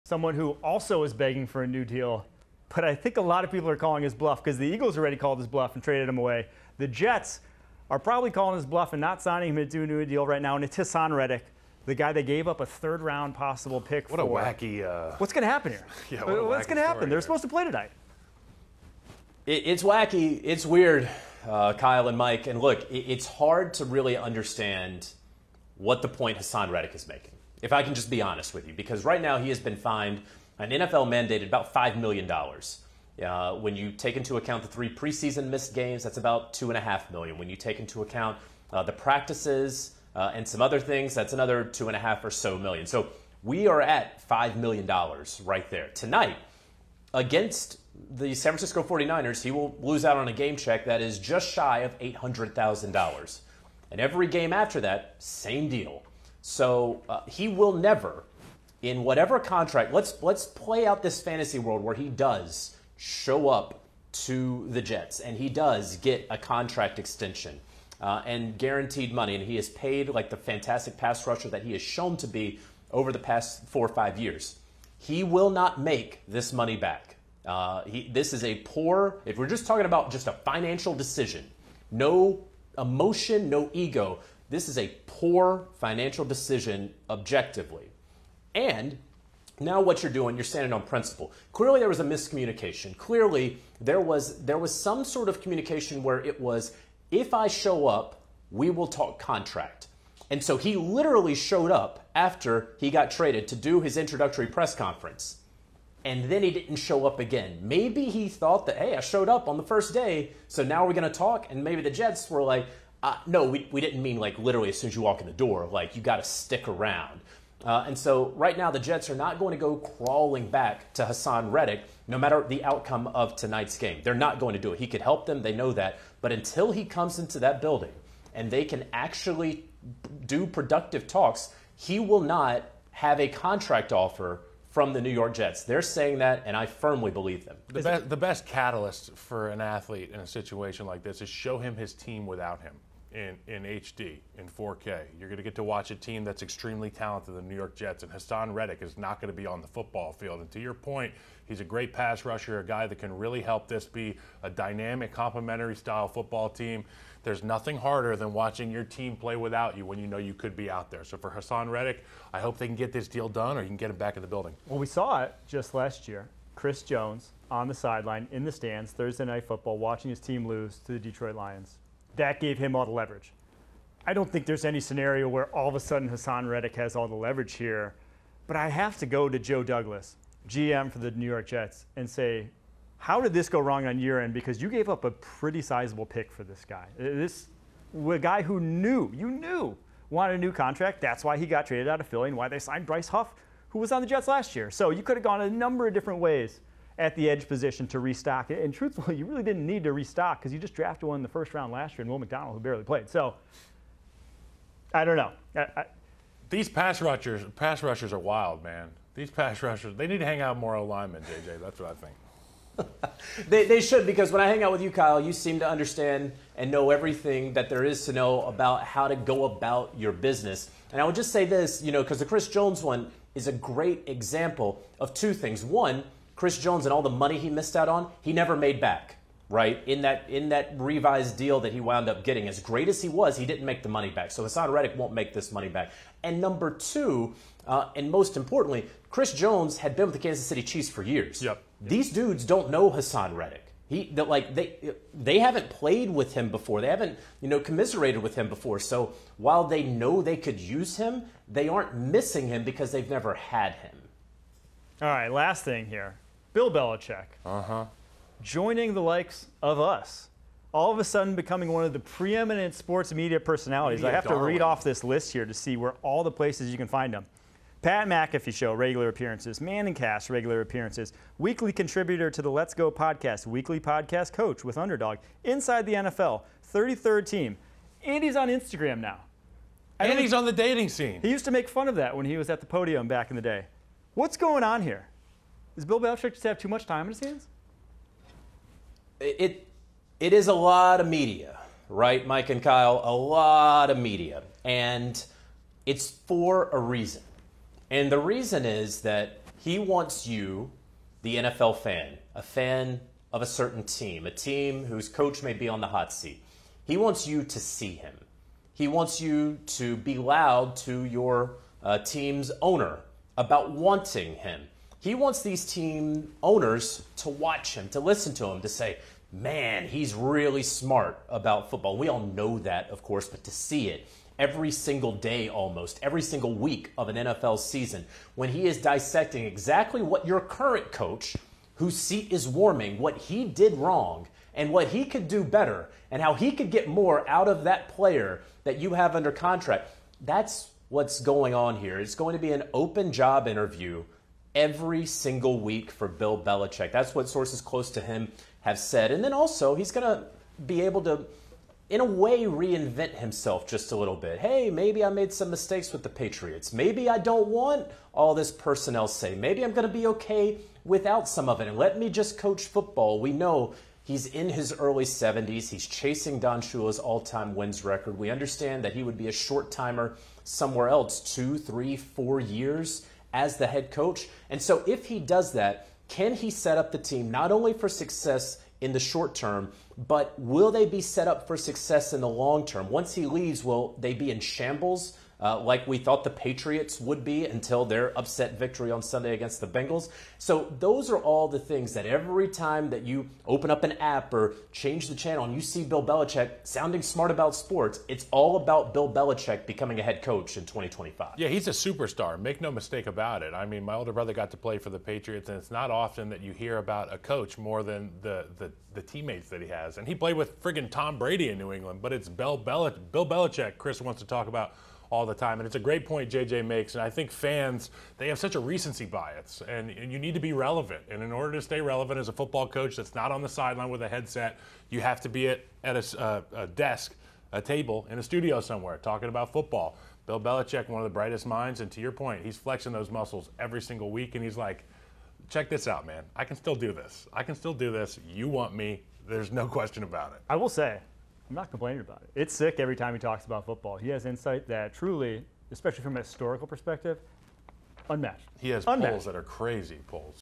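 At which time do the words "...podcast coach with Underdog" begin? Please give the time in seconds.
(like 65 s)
273 s.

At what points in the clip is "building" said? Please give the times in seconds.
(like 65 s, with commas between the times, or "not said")
127 s, 164 s.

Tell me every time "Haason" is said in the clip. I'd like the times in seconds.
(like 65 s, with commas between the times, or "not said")
10 s, 26 s, 121 s, 148 s, 161 s, 176 s, 234 s, 242 s.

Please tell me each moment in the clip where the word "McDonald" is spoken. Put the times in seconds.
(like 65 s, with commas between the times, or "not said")
202 s.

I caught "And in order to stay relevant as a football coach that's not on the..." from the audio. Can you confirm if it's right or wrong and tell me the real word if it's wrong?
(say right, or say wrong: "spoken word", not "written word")
right.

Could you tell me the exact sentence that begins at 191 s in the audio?
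That's why he got traded out of Philly and why they signed Bryce Huff, who was on the Jets last year.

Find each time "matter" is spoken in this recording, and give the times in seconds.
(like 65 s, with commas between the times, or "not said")
122 s.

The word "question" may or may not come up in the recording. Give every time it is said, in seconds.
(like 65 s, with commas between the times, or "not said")
439 s.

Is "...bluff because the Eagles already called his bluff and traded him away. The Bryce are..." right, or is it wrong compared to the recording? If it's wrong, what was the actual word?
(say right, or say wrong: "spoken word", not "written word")
wrong: "Jets", not "Bryce".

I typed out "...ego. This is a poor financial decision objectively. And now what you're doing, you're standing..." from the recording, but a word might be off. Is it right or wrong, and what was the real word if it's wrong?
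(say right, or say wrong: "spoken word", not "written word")
right.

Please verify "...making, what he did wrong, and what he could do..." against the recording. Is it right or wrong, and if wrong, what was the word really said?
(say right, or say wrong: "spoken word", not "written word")
wrong: "warming", not "making".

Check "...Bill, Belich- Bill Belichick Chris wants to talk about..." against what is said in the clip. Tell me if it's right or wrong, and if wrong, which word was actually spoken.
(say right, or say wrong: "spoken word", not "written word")
right.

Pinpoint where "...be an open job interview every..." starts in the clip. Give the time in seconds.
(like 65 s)
342 s.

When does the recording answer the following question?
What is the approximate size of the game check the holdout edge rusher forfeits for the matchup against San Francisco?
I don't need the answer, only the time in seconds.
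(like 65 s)
51 s.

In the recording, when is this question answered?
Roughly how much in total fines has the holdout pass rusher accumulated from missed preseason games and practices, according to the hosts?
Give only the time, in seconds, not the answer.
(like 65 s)
31 s.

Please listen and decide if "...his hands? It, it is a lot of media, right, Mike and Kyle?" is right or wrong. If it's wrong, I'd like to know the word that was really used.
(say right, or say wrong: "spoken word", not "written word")
right.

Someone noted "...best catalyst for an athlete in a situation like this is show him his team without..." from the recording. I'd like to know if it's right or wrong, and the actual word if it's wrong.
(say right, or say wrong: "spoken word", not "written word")
right.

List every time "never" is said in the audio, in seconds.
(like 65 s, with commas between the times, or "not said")
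57 s, 228 s, 253 s.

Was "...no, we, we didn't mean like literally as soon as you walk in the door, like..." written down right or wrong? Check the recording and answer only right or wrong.
right.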